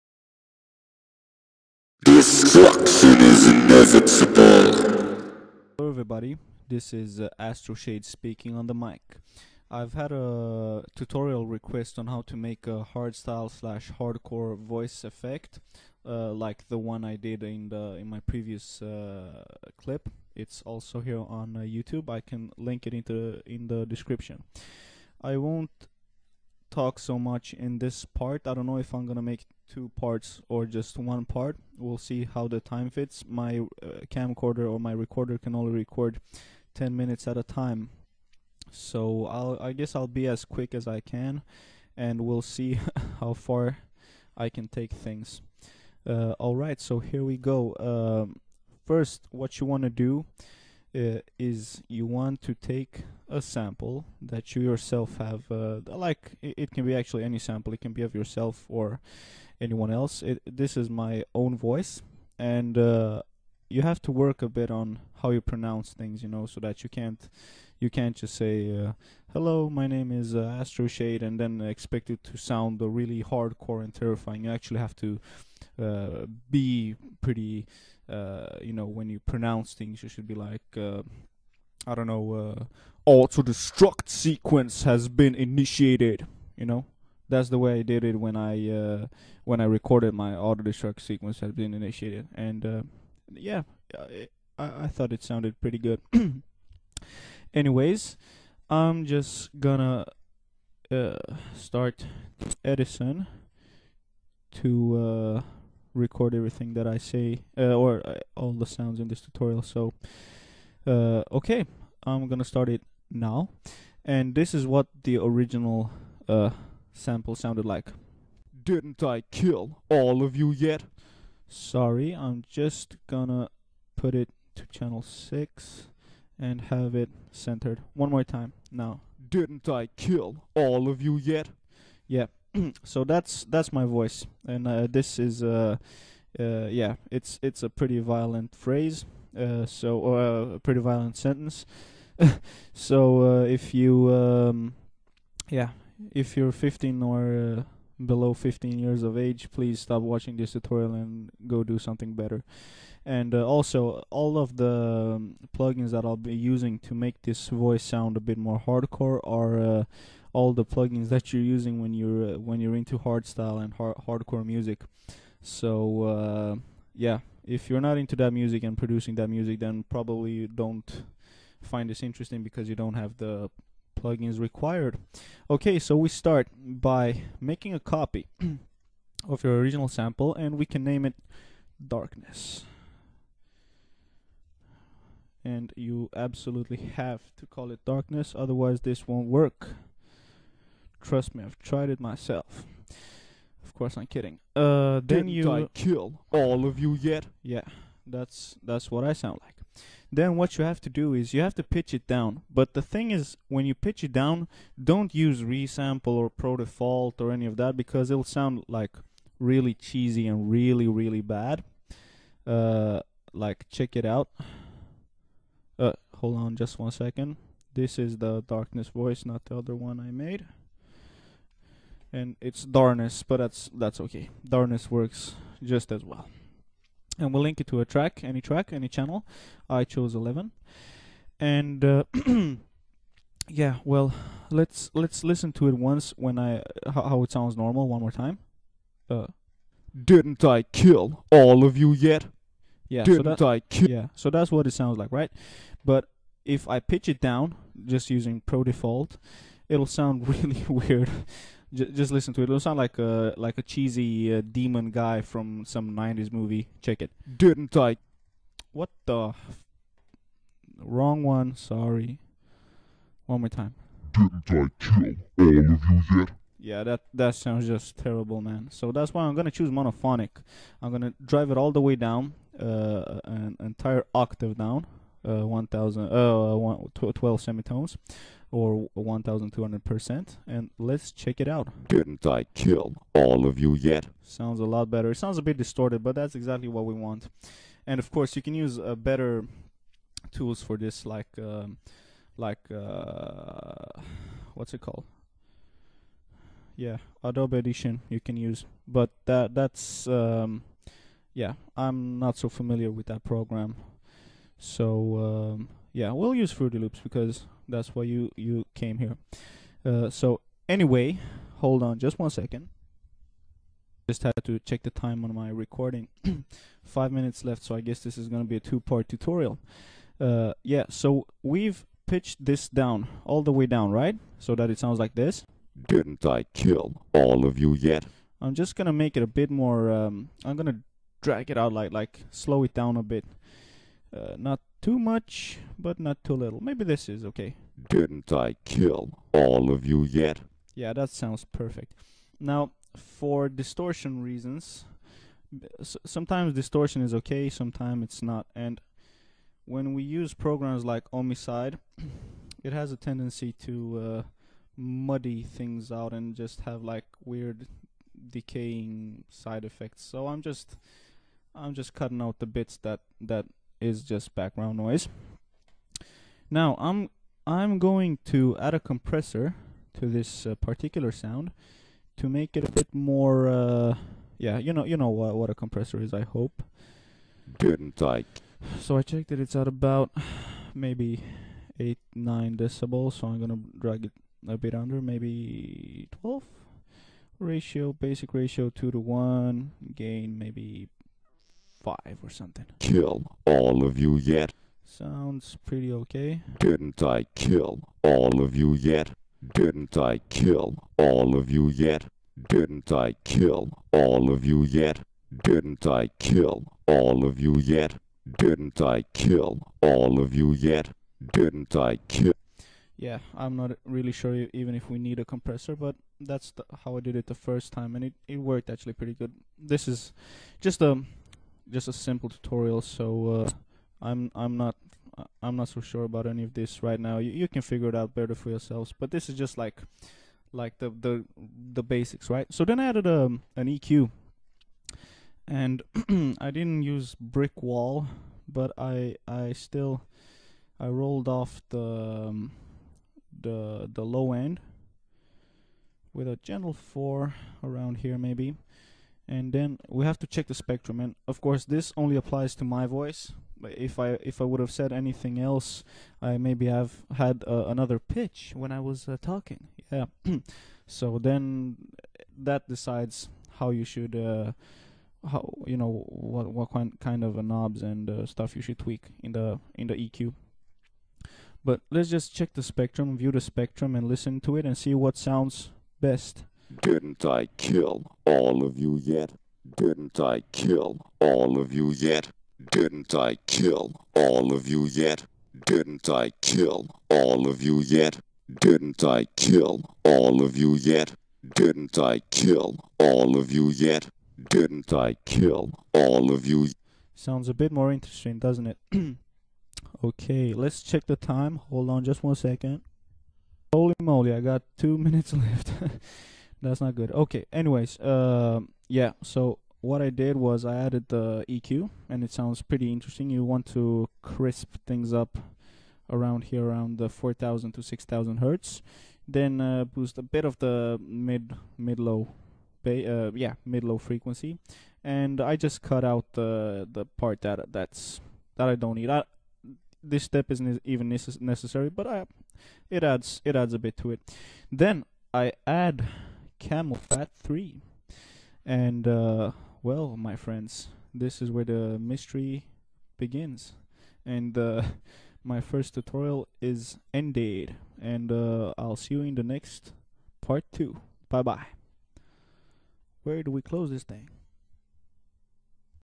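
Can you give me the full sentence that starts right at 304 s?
So, um, yeah, we'll use Fruity Loops because that's why you you came here.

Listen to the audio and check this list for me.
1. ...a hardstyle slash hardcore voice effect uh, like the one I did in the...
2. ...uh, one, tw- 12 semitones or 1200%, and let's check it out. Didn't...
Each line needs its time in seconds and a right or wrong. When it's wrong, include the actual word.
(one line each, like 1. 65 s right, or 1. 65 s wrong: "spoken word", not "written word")
1. 12 s right
2. 276 s right.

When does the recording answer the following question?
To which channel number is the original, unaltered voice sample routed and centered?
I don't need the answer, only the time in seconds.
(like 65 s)
124 s.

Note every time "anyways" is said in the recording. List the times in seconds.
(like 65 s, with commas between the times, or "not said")
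97 s, 310 s, 507 s.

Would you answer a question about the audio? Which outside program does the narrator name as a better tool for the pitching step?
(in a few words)
Adobe Audition.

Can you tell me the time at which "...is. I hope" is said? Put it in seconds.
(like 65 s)
376 s.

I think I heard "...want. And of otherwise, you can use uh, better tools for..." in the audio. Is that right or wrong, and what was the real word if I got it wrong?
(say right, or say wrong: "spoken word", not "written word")
wrong: "course", not "otherwise".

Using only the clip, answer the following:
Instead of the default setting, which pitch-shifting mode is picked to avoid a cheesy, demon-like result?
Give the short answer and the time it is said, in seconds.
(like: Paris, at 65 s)
monophonic, at 269 s.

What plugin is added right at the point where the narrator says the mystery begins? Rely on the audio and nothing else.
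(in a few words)
Camel Fat 3.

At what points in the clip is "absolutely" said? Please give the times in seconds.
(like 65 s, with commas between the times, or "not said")
186 s.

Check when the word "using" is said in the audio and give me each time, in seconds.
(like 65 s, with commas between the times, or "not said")
156 s, 161 s, 248 s.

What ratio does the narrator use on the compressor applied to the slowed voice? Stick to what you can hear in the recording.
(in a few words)
2:1.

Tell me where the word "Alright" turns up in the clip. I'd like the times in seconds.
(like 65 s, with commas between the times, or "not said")
46 s.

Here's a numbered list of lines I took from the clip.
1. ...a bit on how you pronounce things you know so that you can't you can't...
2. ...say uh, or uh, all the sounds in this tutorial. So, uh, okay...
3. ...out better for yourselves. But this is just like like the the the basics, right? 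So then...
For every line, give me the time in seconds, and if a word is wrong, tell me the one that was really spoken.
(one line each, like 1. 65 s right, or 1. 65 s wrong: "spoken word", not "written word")
1. 64 s right
2. 106 s right
3. 427 s right.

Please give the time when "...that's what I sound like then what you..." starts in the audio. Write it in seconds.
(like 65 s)
198 s.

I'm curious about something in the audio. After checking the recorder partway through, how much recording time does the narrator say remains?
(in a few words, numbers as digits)
5 minutes.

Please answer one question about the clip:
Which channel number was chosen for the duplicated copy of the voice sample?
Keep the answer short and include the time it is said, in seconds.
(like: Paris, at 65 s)
11, at 230 s.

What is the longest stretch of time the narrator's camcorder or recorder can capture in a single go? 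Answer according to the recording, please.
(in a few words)
10 minutes.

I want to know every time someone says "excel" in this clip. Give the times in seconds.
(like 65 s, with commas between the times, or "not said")
not said.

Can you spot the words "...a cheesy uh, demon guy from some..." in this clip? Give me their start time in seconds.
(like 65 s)
253 s.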